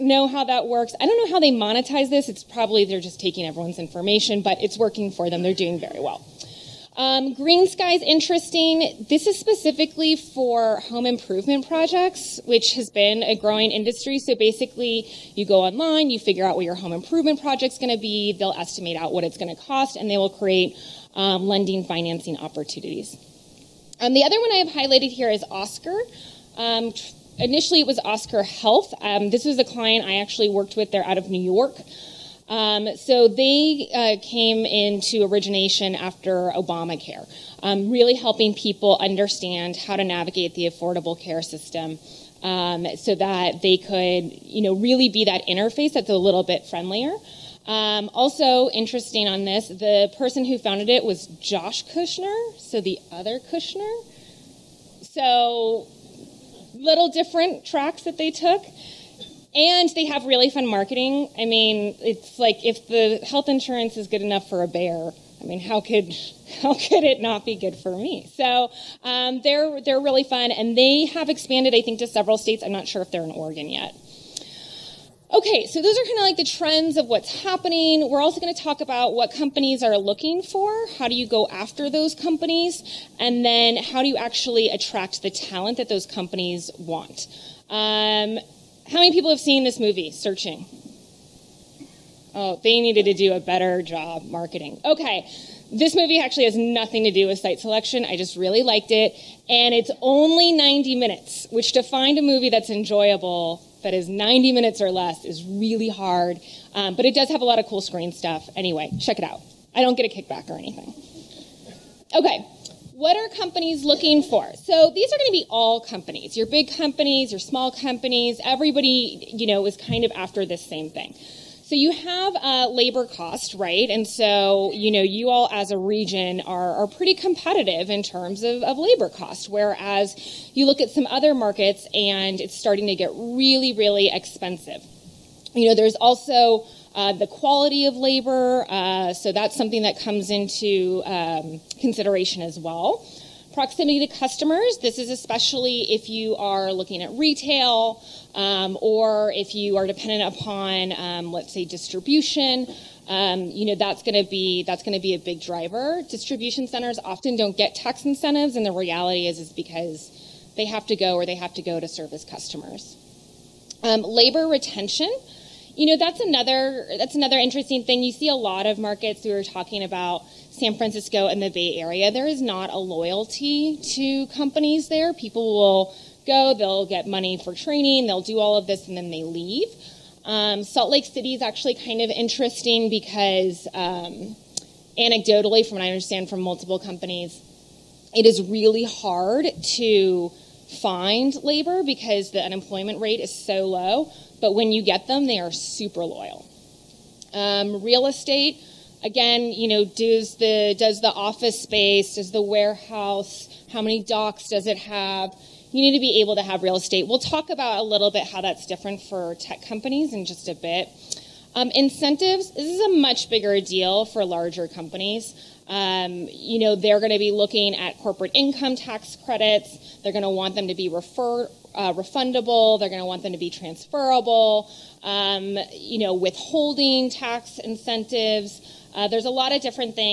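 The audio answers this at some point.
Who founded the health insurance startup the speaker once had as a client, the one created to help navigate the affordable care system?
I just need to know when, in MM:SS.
00:51.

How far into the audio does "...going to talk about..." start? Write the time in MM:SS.
01:18.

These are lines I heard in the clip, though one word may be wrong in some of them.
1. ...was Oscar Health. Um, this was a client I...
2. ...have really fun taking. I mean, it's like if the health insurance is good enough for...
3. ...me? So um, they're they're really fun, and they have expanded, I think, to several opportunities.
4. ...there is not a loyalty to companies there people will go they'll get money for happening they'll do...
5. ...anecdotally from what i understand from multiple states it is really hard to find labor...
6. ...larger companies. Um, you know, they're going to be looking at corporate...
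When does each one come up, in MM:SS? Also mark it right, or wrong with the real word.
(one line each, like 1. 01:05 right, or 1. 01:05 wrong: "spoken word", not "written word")
1. 00:27 right
2. 01:00 wrong: "marketing", not "taking"
3. 01:07 wrong: "states", not "opportunities"
4. 02:52 wrong: "training", not "happening"
5. 03:04 wrong: "companies", not "states"
6. 03:34 right.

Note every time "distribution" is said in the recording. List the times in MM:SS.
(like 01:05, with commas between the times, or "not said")
02:31, 02:36.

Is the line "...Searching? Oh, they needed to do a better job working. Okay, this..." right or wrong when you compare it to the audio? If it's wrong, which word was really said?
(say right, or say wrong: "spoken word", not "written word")
wrong: "marketing", not "working".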